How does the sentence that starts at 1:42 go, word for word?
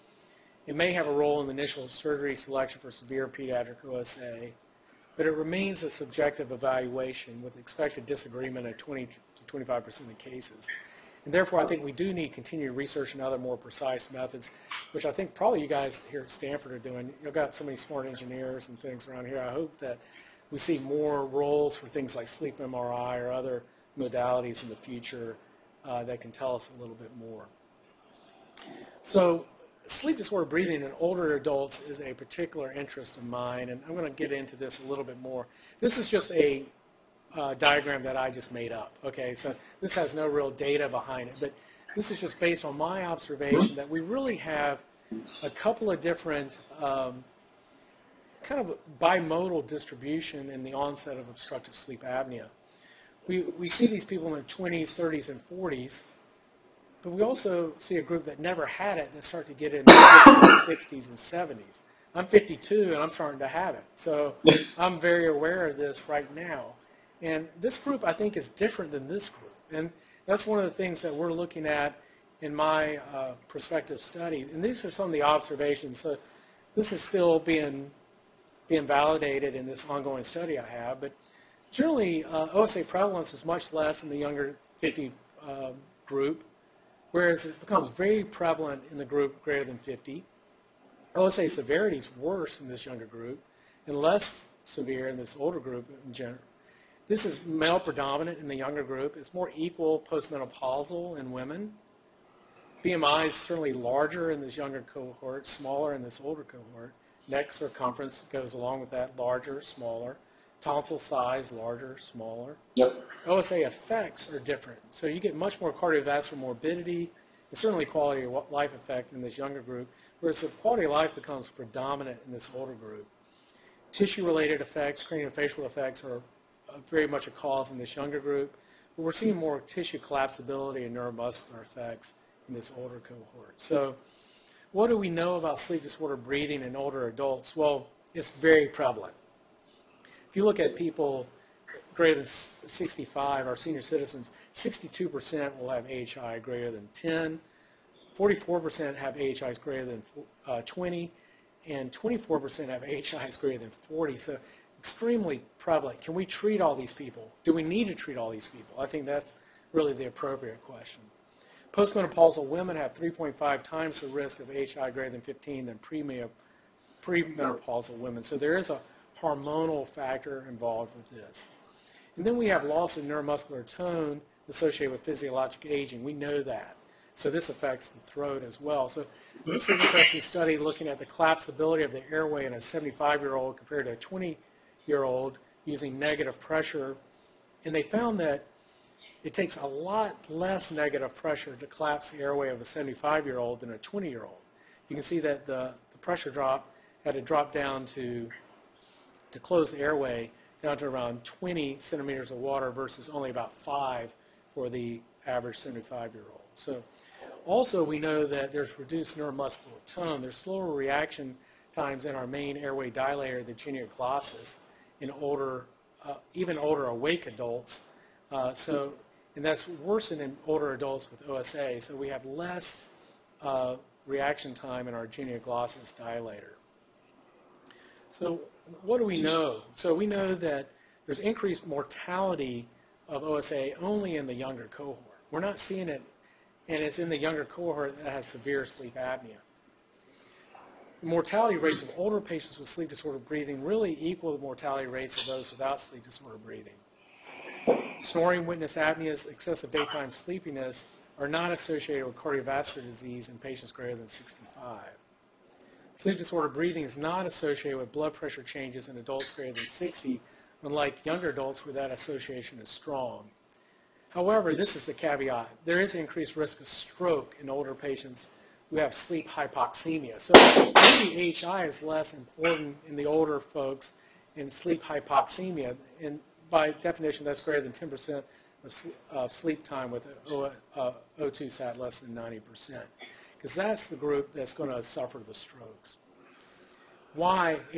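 BMI is certainly larger in this younger cohort, smaller in this older cohort.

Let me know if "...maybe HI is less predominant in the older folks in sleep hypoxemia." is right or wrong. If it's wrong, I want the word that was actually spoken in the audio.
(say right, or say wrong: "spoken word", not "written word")
wrong: "important", not "predominant".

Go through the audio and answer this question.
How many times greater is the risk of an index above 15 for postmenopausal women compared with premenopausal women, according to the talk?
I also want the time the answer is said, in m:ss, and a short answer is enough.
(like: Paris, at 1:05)
3.5, at 2:42.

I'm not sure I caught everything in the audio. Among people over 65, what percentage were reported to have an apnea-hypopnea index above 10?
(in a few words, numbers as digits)
62%.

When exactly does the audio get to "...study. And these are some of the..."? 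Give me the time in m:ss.
1:13.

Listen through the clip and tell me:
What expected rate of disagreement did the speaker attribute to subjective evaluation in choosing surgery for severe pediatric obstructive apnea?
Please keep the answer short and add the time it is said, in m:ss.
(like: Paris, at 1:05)
20 to 25%, at 0:08.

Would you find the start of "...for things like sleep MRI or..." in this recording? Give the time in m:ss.
0:21.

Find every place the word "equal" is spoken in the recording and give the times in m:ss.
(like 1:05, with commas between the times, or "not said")
1:39, 4:04.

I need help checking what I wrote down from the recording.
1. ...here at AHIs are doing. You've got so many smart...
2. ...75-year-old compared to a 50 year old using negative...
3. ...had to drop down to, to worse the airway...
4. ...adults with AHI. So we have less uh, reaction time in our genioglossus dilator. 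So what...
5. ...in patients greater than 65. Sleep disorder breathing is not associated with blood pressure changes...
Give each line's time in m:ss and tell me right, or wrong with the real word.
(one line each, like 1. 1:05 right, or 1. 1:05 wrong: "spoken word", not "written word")
1. 0:16 wrong: "Stanford", not "AHIs"
2. 3:02 wrong: "20", not "50"
3. 3:17 wrong: "close", not "worse"
4. 3:40 wrong: "OSA", not "AHI"
5. 4:13 right.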